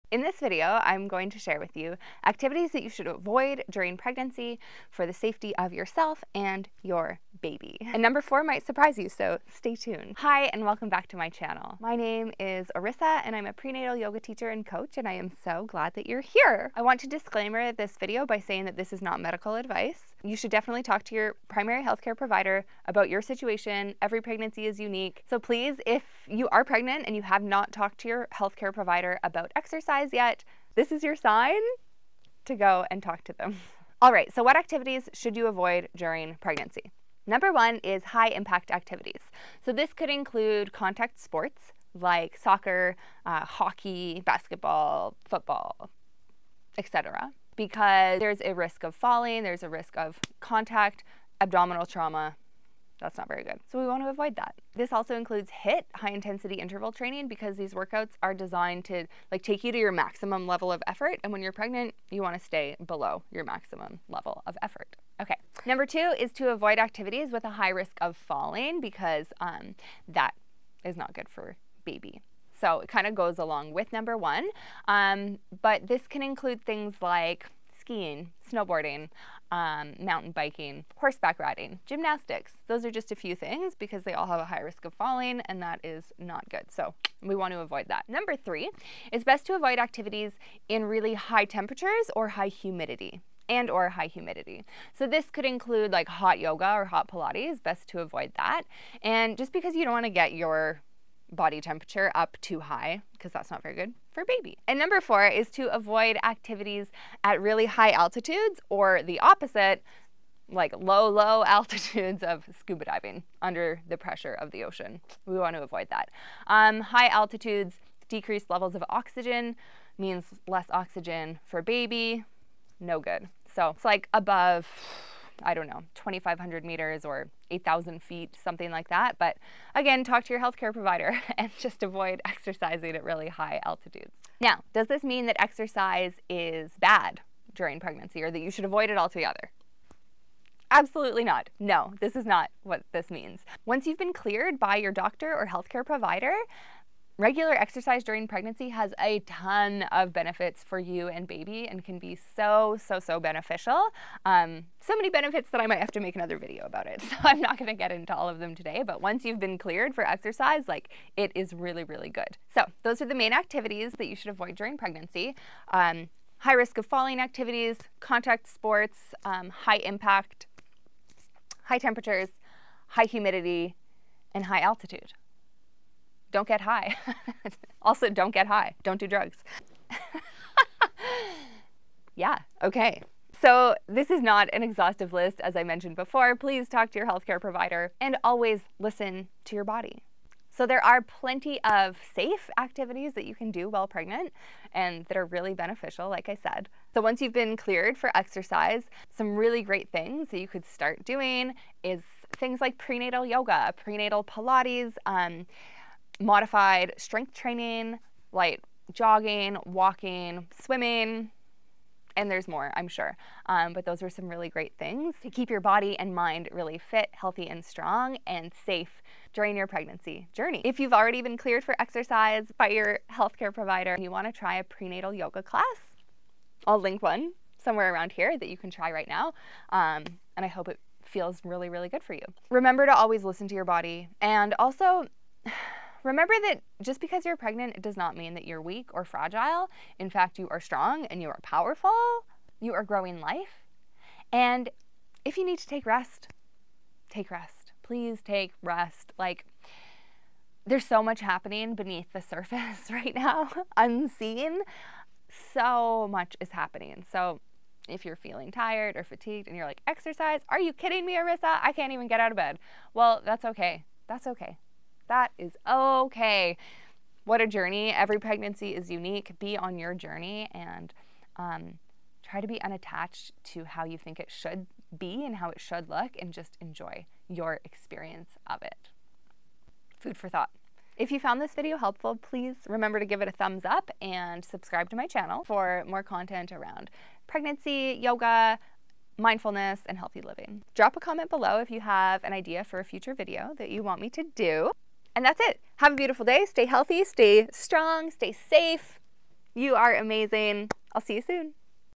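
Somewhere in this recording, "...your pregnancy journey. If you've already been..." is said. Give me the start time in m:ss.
3:39.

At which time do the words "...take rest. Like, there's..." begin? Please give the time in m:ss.
4:08.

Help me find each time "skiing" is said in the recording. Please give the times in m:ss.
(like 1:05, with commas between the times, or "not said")
1:17.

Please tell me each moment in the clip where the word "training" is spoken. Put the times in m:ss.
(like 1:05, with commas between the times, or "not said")
0:56, 3:27.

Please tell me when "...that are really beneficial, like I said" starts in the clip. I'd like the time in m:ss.
3:15.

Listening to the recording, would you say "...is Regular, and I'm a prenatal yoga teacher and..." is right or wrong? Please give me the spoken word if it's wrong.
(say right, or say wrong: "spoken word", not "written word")
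wrong: "Orissa", not "Regular".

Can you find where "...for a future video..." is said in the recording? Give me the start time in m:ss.
4:52.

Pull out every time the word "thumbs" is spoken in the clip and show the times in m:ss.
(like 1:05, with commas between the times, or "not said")
4:43.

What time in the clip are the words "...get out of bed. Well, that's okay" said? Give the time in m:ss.
4:22.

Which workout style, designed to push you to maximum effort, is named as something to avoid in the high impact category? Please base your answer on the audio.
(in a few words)
HIIT.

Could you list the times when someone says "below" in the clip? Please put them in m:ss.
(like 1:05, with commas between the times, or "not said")
1:02, 4:51.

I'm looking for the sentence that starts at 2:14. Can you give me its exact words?
Now, does this mean that exercise is bad during pregnancy or that you should avoid it altogether?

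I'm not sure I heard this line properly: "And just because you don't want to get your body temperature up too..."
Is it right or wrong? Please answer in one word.
right.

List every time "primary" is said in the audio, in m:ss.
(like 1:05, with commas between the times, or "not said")
0:21.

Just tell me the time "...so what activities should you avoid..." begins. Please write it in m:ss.
0:34.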